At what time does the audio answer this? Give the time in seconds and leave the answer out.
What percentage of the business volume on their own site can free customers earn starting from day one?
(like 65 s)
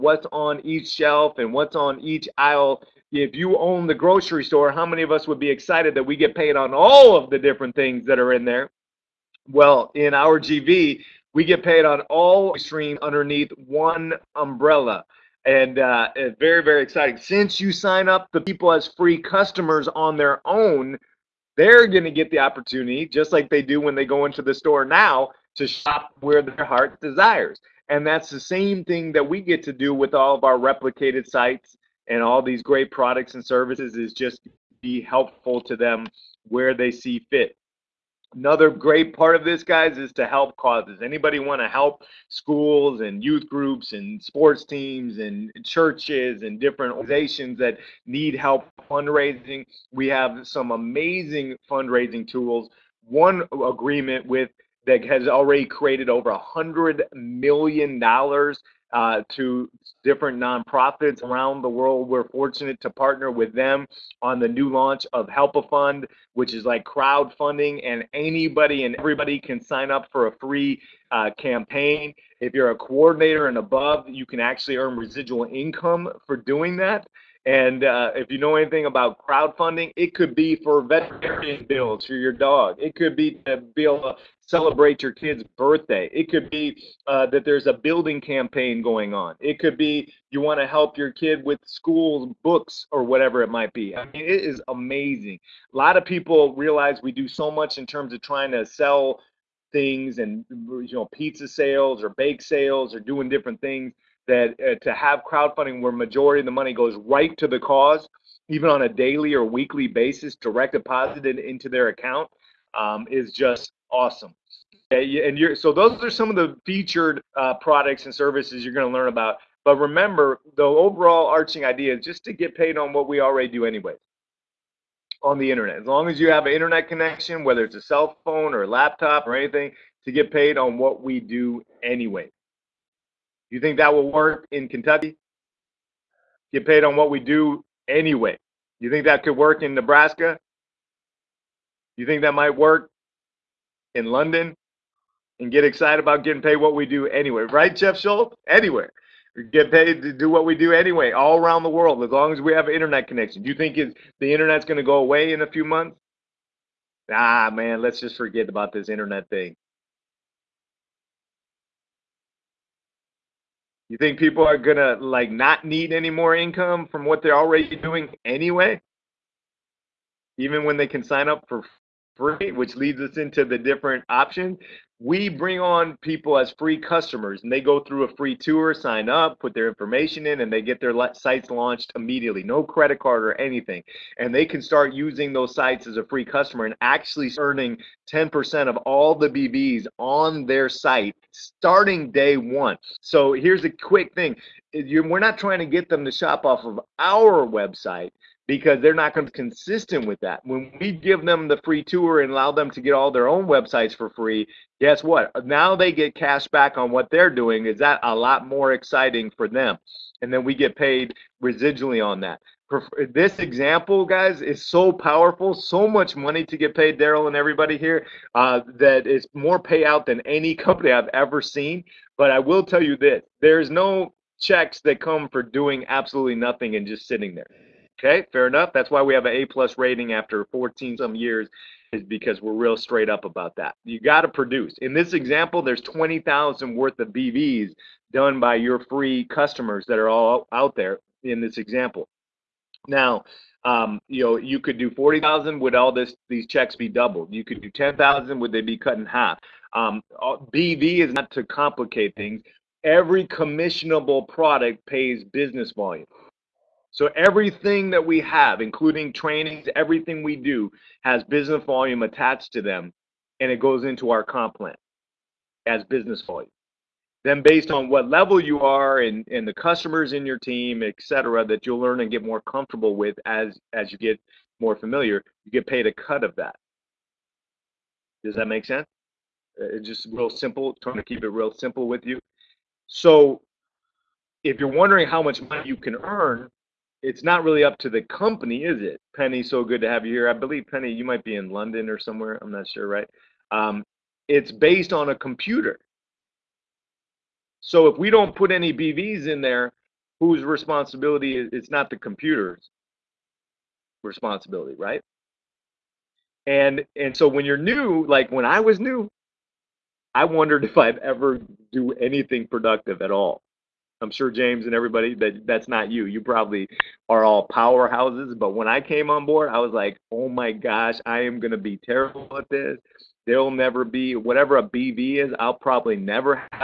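188 s.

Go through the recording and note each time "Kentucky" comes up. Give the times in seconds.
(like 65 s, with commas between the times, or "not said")
134 s.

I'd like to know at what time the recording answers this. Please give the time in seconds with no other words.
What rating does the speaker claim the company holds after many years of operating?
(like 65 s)
229 s.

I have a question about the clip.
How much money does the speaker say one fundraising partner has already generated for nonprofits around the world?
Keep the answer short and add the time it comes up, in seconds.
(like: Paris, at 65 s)
$100 million, at 56 s.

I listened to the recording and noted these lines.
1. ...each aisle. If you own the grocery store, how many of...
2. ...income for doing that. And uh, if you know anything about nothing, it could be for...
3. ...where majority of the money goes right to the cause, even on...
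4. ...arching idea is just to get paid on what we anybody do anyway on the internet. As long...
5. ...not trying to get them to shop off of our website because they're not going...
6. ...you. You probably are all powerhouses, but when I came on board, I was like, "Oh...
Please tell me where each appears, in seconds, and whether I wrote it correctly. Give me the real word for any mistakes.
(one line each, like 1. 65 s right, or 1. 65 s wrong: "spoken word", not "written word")
1. 1 s right
2. 75 s wrong: "crowdfunding", not "nothing"
3. 105 s right
4. 121 s wrong: "already", not "anybody"
5. 195 s right
6. 315 s right.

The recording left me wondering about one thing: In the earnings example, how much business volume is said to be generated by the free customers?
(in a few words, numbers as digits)
20,000.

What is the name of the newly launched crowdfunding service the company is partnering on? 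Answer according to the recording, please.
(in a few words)
Help a Fund.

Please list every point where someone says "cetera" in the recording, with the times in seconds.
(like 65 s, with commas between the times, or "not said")
270 s.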